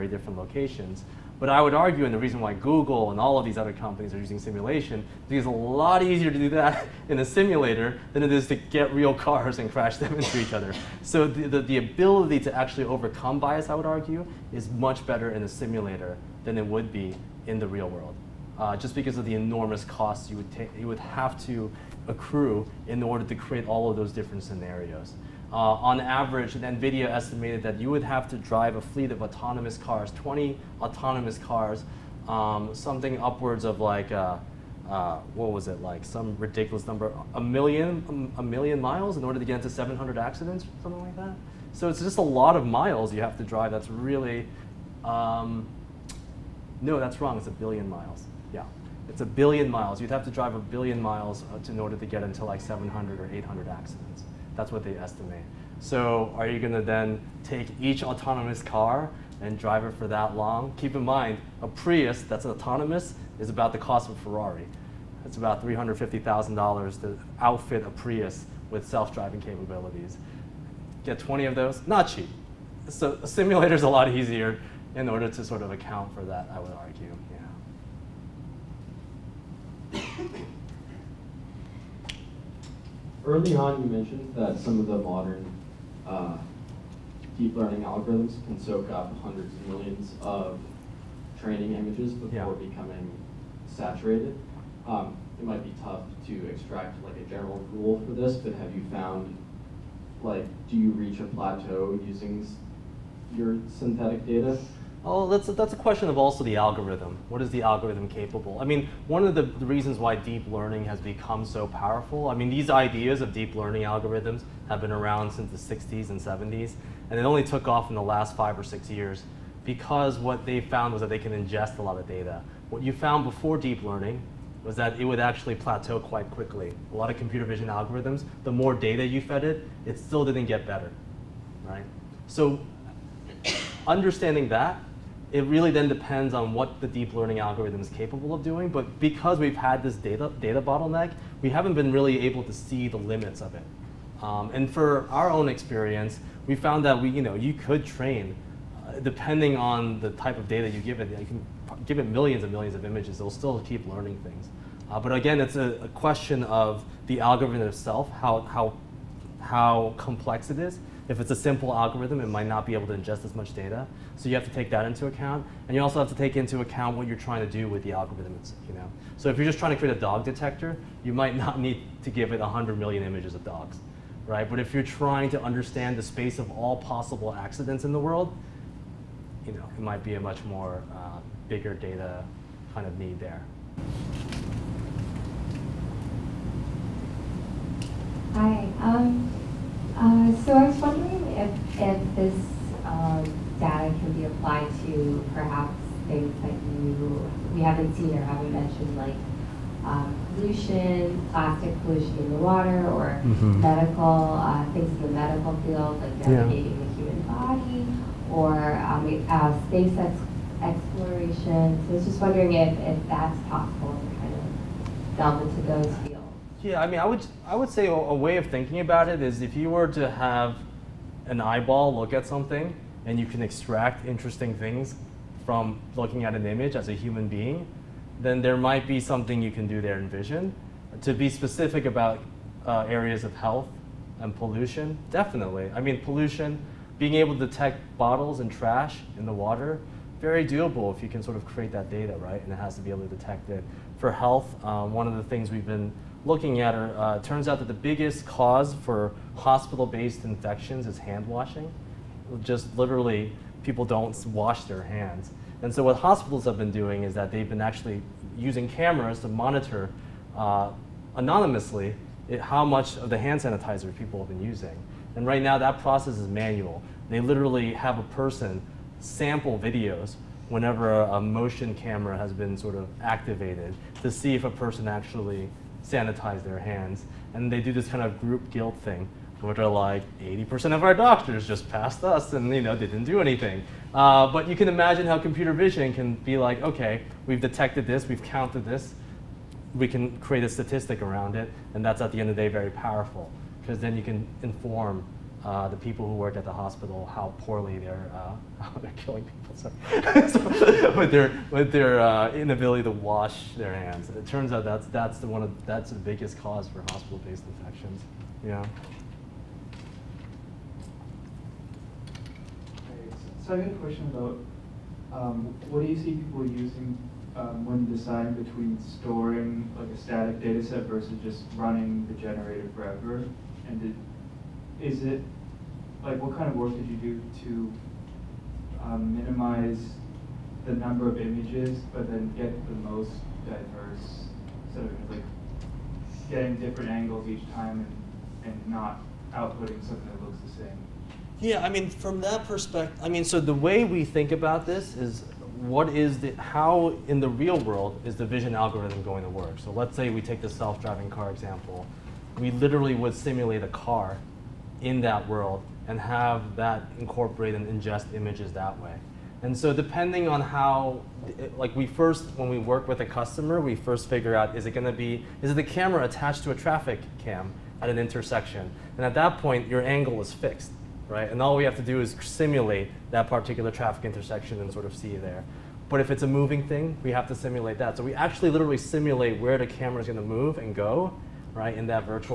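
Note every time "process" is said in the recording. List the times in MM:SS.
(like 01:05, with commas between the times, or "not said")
04:25.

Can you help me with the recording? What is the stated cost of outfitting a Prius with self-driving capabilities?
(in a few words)
$350,000.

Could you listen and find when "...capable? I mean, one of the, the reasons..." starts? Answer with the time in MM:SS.
01:48.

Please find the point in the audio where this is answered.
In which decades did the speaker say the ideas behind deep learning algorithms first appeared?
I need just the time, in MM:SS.
01:55.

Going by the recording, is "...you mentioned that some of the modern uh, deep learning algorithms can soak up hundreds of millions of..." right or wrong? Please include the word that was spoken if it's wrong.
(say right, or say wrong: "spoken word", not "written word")
right.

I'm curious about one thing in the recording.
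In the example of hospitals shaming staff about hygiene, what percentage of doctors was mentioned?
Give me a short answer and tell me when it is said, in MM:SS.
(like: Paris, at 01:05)
80%, at 04:40.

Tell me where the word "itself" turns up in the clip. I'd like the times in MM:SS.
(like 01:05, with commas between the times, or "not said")
02:37, 02:48.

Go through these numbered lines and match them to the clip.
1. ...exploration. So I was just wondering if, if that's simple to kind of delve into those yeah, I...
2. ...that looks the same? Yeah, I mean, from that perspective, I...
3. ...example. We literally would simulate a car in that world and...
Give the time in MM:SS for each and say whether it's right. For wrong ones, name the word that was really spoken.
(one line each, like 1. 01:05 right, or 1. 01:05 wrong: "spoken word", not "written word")
1. 03:30 wrong: "possible", not "simple"
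2. 05:40 right
3. 05:51 right.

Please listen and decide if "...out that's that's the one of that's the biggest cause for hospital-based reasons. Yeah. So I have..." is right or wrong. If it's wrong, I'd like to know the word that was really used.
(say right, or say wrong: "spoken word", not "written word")
wrong: "infections", not "reasons".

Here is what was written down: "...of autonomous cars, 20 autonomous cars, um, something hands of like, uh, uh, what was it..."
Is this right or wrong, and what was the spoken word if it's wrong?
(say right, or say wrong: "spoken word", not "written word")
wrong: "upwards", not "hands".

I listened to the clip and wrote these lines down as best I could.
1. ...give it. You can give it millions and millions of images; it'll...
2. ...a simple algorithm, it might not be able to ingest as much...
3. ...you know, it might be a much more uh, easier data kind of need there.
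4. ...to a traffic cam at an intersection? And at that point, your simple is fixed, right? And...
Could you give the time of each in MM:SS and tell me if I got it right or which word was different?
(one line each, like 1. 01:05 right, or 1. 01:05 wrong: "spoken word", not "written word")
1. 02:30 right
2. 02:41 right
3. 02:59 wrong: "bigger", not "easier"
4. 06:06 wrong: "angle", not "simple".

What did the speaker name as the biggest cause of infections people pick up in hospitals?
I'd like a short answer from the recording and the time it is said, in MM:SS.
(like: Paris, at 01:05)
hand washing, at 04:10.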